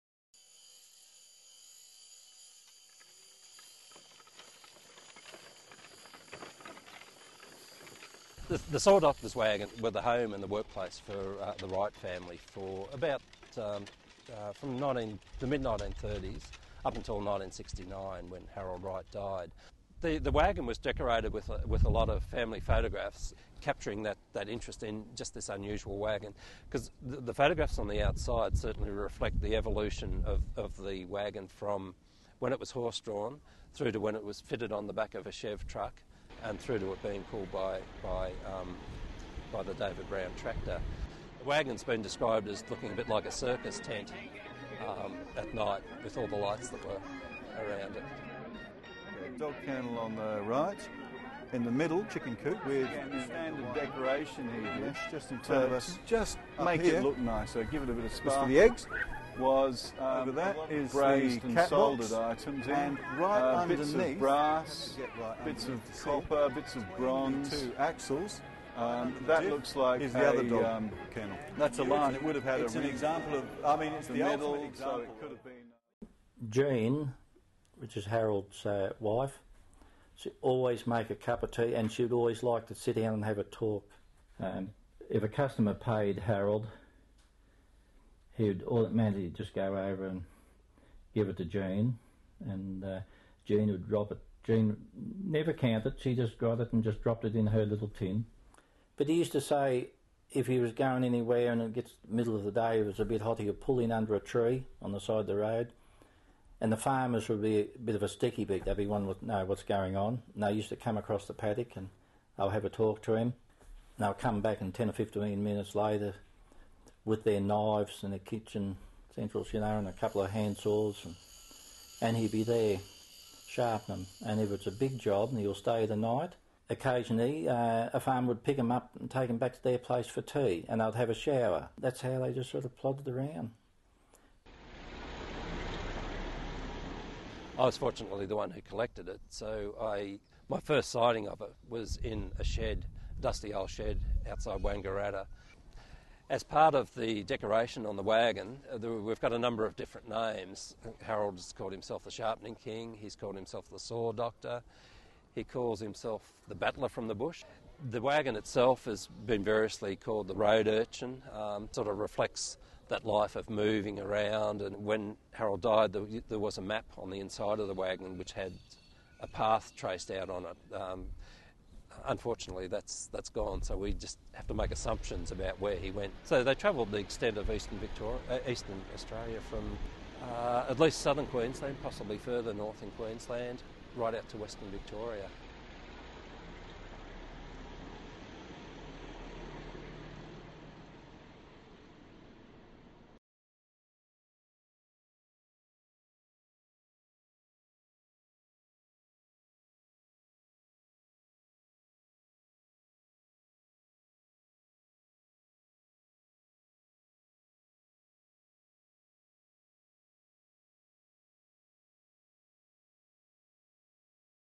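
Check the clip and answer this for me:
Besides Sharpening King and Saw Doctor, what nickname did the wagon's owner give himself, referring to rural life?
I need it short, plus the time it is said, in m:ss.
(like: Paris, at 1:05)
Battler from the Bush, at 2:36.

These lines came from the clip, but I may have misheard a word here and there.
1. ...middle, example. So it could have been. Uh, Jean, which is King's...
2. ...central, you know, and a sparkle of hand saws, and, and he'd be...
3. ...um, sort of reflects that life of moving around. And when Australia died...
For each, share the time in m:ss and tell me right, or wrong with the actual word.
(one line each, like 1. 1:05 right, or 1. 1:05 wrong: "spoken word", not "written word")
1. 1:14 wrong: "Harold", not "King"
2. 1:59 wrong: "couple", not "sparkle"
3. 2:41 wrong: "Harold", not "Australia".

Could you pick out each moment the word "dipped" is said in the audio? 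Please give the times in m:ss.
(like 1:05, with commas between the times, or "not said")
not said.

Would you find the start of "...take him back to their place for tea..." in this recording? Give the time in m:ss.
2:09.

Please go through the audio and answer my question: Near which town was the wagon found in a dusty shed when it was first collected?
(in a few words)
Wangaratta.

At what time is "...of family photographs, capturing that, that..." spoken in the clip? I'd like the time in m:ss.
0:22.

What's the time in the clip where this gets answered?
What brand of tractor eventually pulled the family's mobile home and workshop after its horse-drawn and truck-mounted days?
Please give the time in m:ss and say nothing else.
0:39.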